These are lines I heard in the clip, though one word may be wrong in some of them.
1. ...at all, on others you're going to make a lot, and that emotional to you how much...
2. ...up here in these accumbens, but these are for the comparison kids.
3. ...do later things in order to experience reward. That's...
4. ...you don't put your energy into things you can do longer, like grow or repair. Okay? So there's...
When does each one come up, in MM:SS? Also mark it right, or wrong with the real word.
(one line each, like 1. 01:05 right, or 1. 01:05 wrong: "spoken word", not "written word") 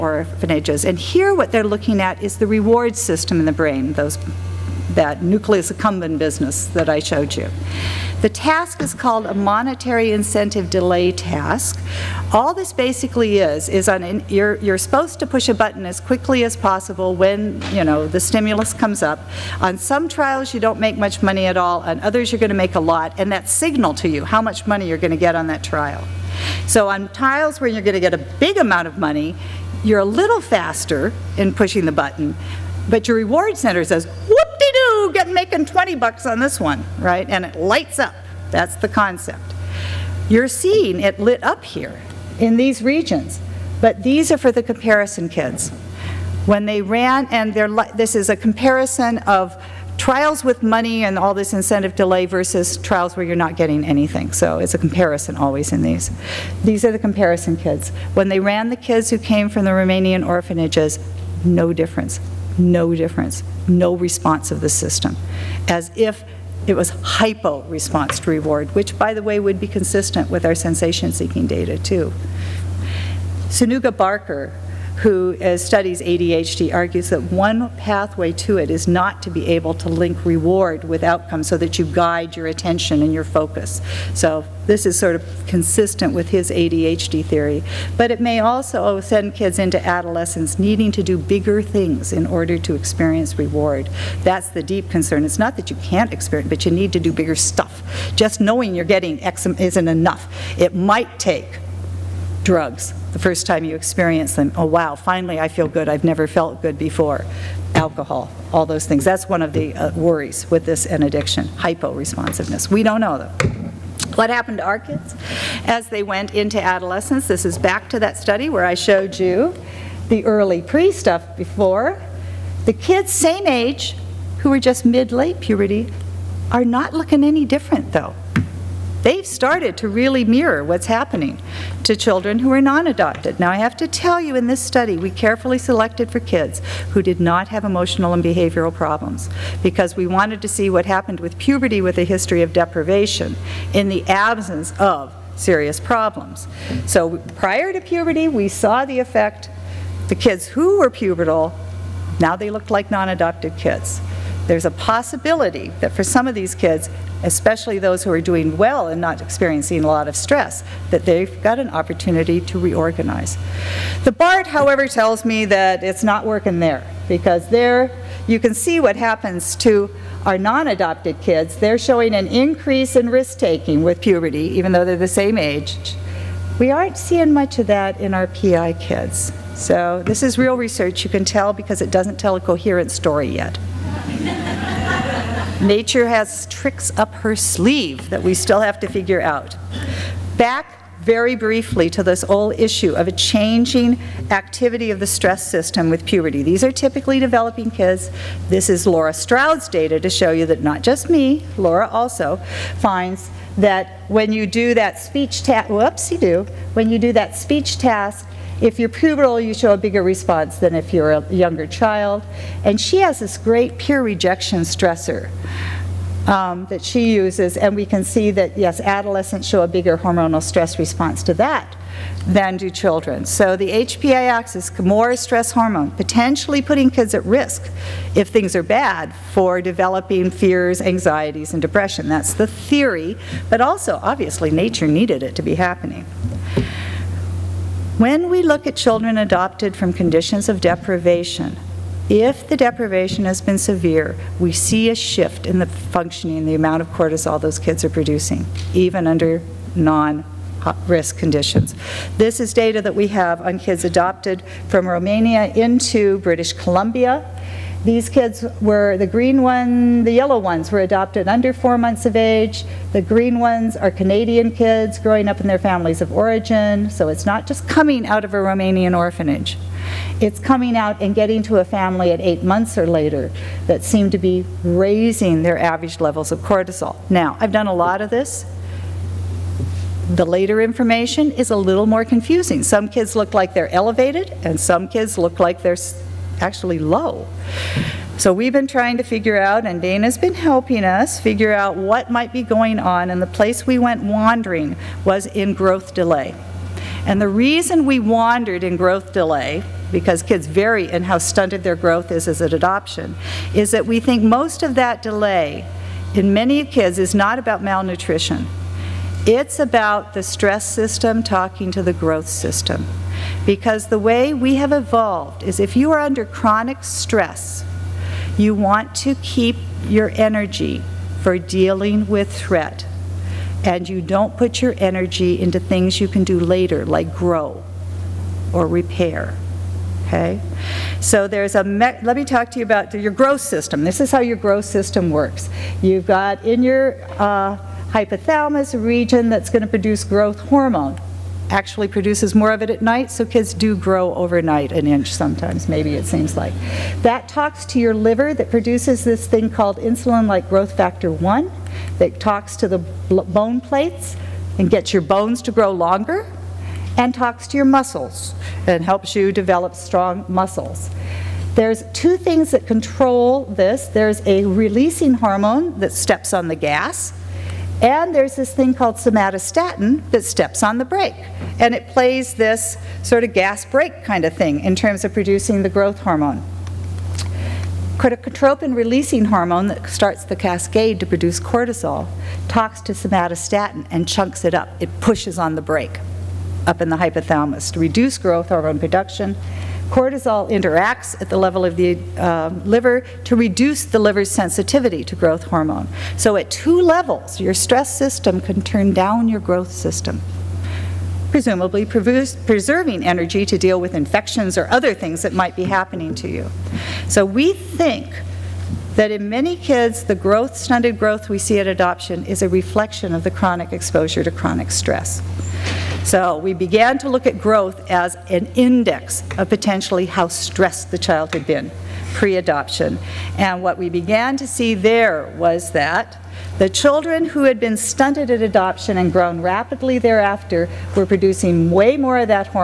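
1. 00:21 wrong: "signal", not "emotional"
2. 00:41 wrong: "regions", not "accumbens"
3. 01:31 wrong: "bigger", not "later"
4. 05:23 wrong: "later", not "longer".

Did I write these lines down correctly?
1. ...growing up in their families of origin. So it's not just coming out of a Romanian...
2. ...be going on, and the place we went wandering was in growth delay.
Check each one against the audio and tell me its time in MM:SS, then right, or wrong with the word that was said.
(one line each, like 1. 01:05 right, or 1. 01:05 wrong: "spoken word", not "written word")
1. 04:24 right
2. 04:52 right.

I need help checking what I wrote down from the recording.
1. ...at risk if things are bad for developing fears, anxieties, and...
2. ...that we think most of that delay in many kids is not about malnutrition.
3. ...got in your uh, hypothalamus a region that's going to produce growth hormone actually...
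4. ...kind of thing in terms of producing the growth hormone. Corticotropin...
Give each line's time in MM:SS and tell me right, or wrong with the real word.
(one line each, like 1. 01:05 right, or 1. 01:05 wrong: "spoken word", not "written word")
1. 03:47 right
2. 05:03 right
3. 05:36 right
4. 06:14 right.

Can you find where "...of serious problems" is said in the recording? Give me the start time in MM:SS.
02:24.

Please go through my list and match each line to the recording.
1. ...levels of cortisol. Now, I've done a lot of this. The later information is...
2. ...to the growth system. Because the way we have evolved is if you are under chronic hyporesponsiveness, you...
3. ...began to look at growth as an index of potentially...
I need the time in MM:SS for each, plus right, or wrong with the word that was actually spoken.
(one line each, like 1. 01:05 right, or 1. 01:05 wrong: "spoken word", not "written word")
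1. 04:35 right
2. 05:11 wrong: "stress", not "hyporesponsiveness"
3. 06:56 right.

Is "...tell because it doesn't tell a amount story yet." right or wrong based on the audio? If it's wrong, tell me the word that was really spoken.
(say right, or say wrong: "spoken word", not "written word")
wrong: "coherent", not "amount".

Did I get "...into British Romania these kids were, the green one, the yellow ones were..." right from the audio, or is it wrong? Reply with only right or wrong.
wrong.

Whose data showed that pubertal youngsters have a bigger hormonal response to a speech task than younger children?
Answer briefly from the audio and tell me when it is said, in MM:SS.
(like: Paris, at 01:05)
Laura Stroud, at 03:18.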